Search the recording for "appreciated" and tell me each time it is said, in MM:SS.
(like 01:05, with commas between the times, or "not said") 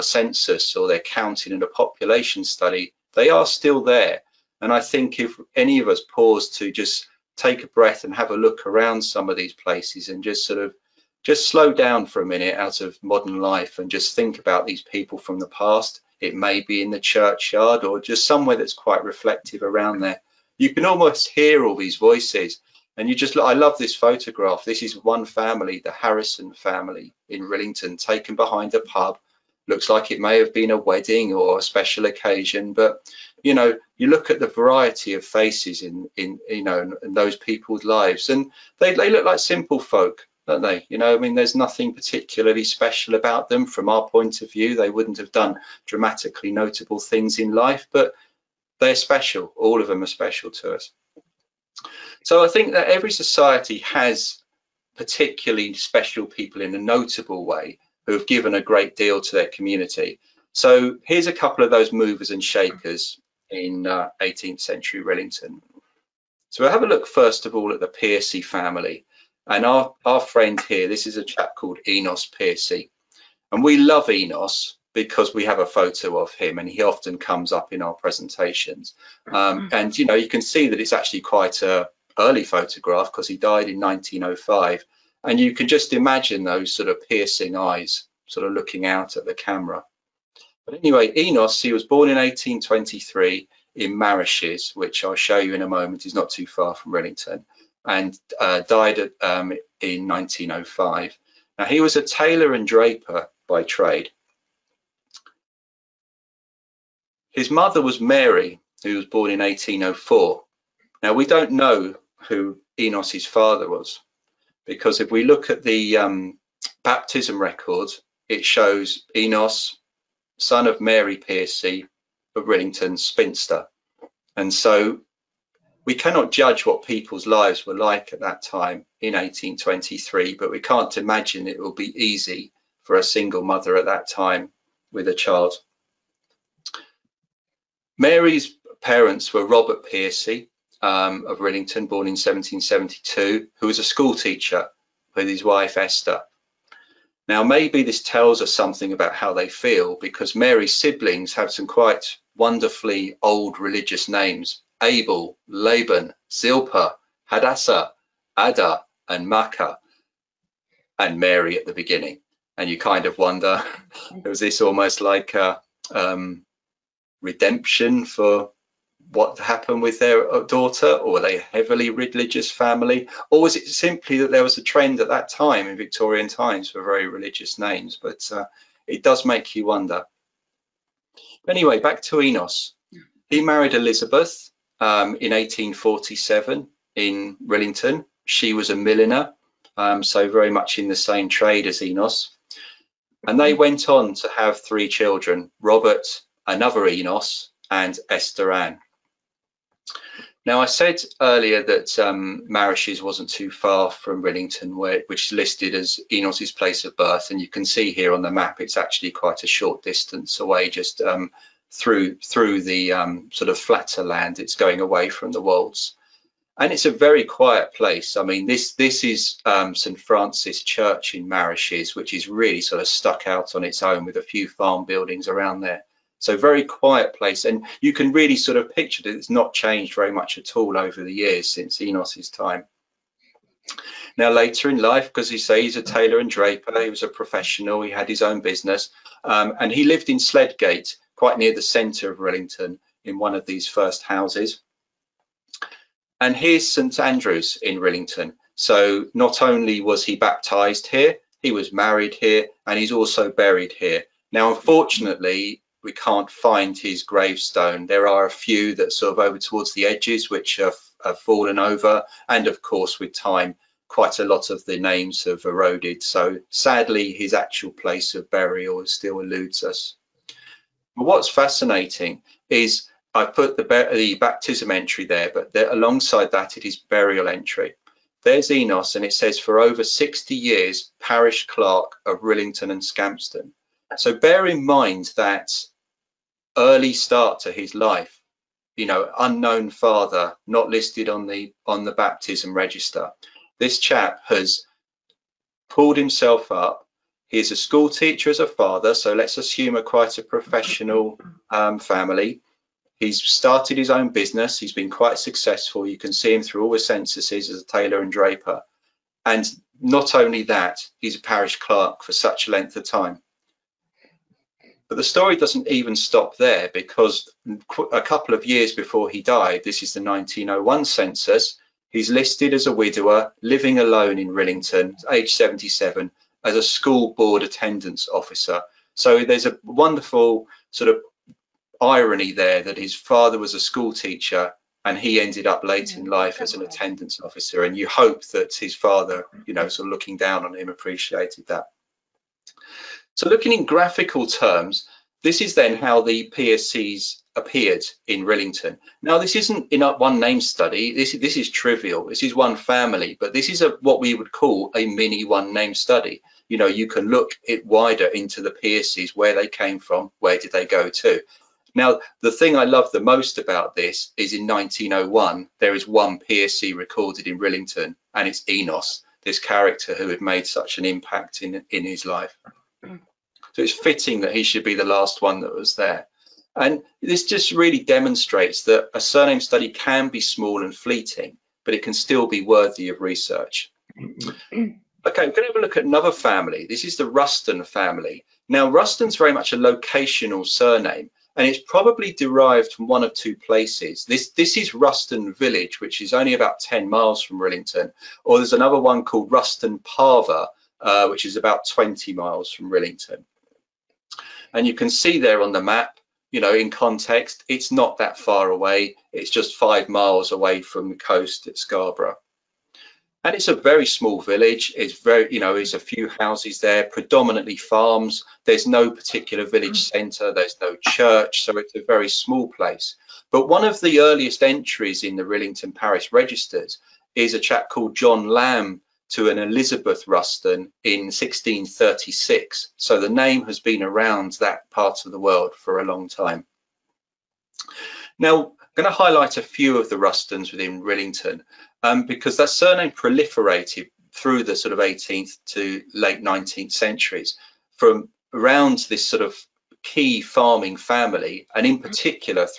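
05:40.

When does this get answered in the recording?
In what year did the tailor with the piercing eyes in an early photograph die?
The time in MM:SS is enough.
01:23.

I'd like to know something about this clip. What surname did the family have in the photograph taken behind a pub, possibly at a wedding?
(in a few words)
Harrison.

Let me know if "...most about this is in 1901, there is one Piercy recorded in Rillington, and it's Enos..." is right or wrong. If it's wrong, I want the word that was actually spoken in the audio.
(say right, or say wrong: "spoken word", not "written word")
right.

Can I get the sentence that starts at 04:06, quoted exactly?
And here's St Andrews in Rillington.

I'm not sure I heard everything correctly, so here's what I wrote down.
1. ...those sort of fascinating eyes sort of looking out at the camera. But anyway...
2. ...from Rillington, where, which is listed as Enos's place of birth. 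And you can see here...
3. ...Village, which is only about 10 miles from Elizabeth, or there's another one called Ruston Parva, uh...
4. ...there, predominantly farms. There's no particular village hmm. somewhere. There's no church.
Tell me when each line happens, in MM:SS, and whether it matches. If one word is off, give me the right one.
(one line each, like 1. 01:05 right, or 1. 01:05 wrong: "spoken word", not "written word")
1. 01:26 wrong: "piercing", not "fascinating"
2. 03:23 right
3. 06:35 wrong: "Rillington", not "Elizabeth"
4. 06:56 wrong: "centre", not "somewhere".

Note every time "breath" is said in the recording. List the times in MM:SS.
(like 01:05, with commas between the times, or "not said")
00:07.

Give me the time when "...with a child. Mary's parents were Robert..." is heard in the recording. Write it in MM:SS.
02:14.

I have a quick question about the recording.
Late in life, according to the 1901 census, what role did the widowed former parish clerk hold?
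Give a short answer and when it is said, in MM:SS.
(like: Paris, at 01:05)
School board attendance officer, at 05:26.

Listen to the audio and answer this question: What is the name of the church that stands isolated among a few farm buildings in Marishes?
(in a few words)
St. Francis Church.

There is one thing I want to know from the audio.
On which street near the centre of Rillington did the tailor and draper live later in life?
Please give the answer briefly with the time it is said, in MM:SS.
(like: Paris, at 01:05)
Sledgate, at 04:00.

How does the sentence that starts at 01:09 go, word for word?
And our, our friend here, this is a chap called Enos Piercy.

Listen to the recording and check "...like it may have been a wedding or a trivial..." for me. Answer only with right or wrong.
wrong.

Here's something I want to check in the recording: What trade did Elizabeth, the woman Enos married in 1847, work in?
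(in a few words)
Milliner.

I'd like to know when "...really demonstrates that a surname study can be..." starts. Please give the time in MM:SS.
06:17.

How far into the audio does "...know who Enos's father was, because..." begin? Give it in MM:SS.
01:51.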